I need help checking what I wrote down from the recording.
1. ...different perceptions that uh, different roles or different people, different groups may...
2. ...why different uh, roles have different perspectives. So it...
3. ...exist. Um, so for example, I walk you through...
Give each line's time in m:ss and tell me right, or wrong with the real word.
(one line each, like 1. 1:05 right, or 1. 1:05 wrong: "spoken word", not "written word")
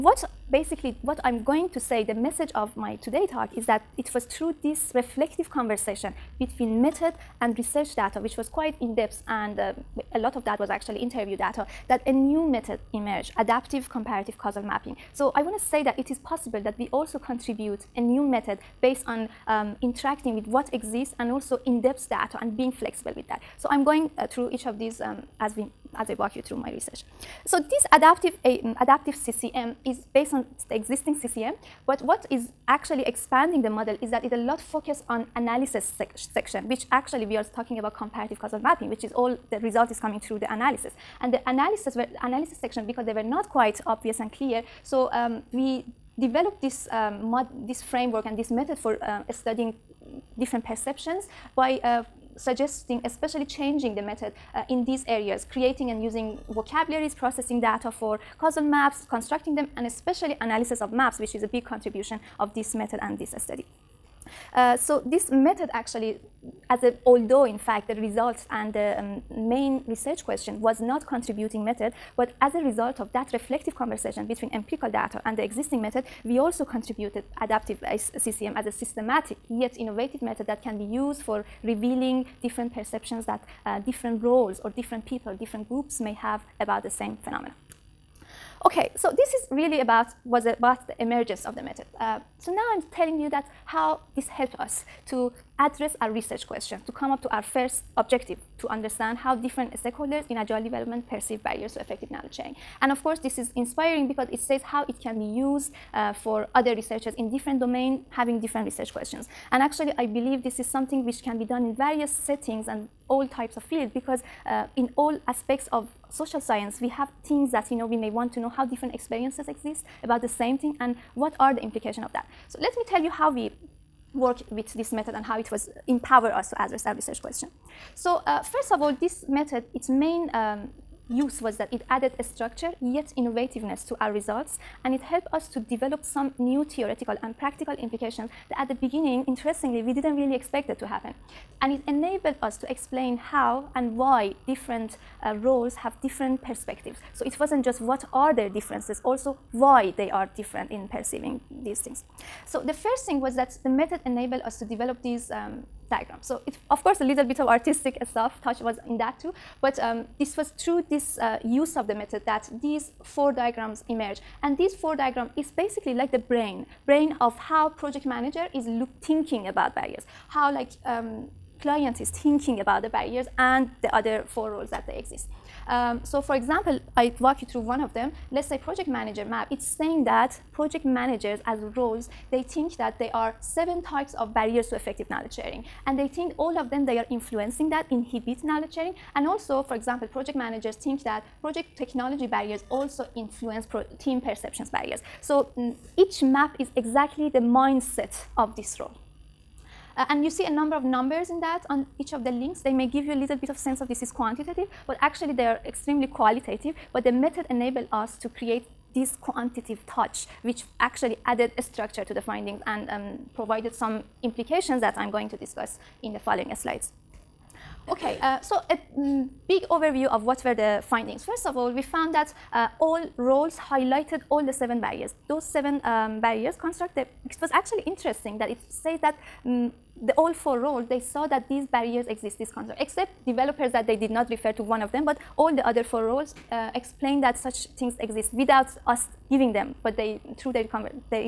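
1. 1:22 right
2. 2:23 right
3. 2:54 right.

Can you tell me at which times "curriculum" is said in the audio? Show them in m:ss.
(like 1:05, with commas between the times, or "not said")
not said.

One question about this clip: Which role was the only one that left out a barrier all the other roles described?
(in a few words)
developers.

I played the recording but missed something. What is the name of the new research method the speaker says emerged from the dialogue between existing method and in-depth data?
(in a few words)
adaptive comparative causal mapping.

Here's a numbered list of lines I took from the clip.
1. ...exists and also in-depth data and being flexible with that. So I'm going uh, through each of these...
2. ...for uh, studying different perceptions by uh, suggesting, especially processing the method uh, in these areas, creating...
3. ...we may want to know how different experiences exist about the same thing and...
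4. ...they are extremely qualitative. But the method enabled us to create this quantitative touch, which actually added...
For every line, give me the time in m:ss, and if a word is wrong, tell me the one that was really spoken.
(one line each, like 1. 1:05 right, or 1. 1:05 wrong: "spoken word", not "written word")
1. 0:20 right
2. 0:48 wrong: "changing", not "processing"
3. 1:57 right
4. 3:25 right.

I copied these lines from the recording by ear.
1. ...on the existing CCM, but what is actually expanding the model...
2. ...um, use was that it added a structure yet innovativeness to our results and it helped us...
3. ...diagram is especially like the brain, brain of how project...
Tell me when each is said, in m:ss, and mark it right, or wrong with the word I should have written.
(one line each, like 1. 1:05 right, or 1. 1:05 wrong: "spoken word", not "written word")
1. 0:30 right
2. 2:10 right
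3. 2:44 wrong: "basically", not "especially".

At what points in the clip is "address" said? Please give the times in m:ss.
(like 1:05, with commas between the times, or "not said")
1:35, 2:06.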